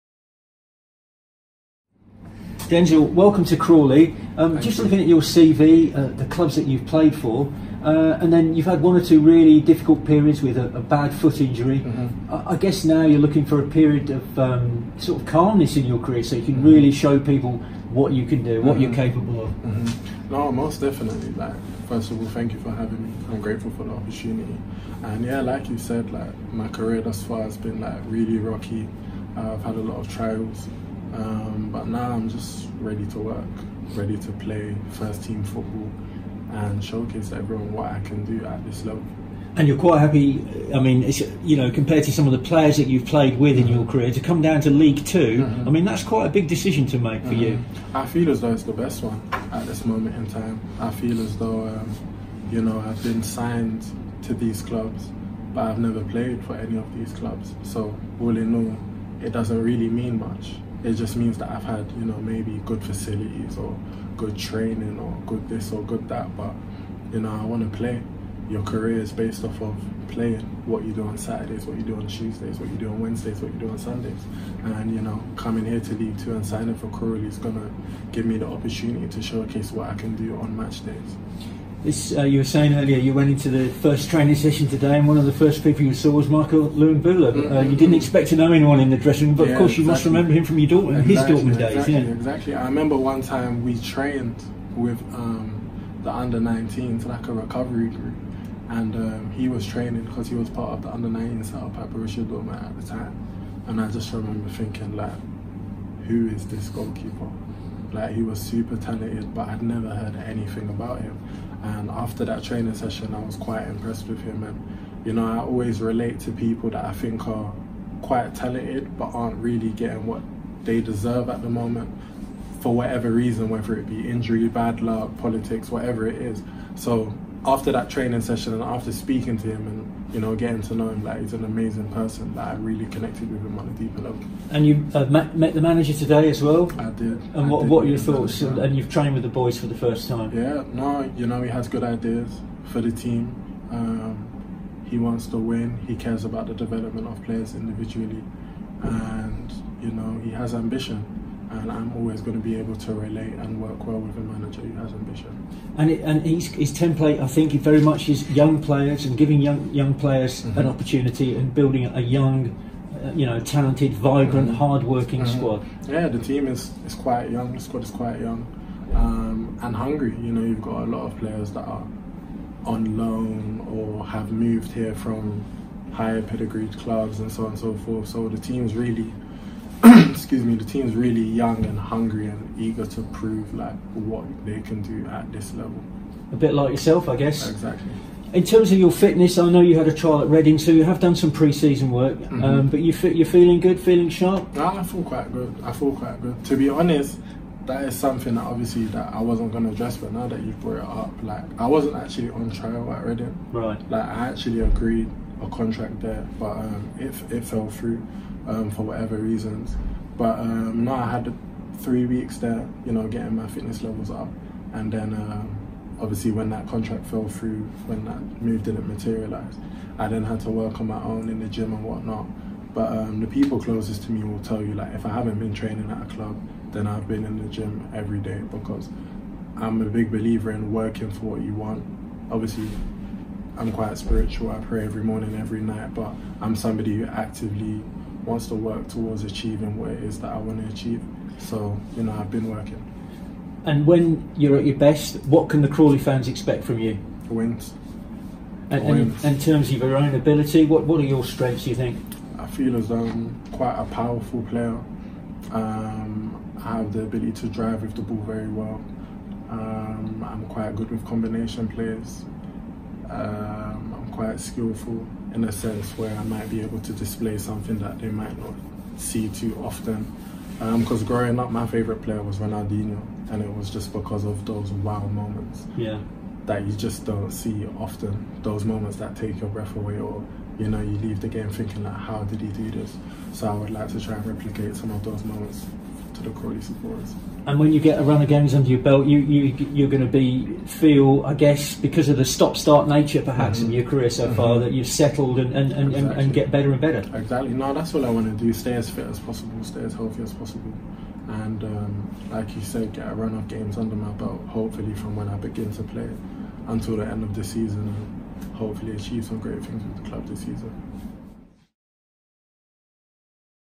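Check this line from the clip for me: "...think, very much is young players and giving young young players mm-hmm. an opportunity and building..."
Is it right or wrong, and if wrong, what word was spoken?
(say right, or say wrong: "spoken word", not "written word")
right.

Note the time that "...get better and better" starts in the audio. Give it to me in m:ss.
4:56.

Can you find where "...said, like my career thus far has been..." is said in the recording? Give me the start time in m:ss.
0:25.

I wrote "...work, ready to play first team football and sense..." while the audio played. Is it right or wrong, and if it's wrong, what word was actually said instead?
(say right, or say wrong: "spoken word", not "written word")
wrong: "showcase", not "sense".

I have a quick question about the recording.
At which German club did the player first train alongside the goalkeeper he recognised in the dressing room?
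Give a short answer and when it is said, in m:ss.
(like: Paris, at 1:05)
Borussia Dortmund, at 1:41.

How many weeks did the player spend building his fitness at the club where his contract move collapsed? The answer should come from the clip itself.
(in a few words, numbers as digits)
3.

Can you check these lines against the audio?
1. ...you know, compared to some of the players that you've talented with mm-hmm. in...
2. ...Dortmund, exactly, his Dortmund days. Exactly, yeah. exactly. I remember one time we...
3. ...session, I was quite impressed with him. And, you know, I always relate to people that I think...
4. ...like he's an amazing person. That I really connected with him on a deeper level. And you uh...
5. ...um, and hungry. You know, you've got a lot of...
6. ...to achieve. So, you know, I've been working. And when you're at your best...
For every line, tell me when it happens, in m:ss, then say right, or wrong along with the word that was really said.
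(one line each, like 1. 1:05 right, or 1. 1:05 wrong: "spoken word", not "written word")
1. 0:41 wrong: "played", not "talented"
2. 1:30 right
3. 1:52 right
4. 2:11 right
5. 2:48 right
6. 4:00 right.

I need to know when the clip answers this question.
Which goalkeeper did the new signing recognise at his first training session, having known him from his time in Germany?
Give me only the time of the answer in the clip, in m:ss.
1:26.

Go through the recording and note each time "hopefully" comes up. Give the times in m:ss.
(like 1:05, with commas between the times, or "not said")
5:04, 5:08.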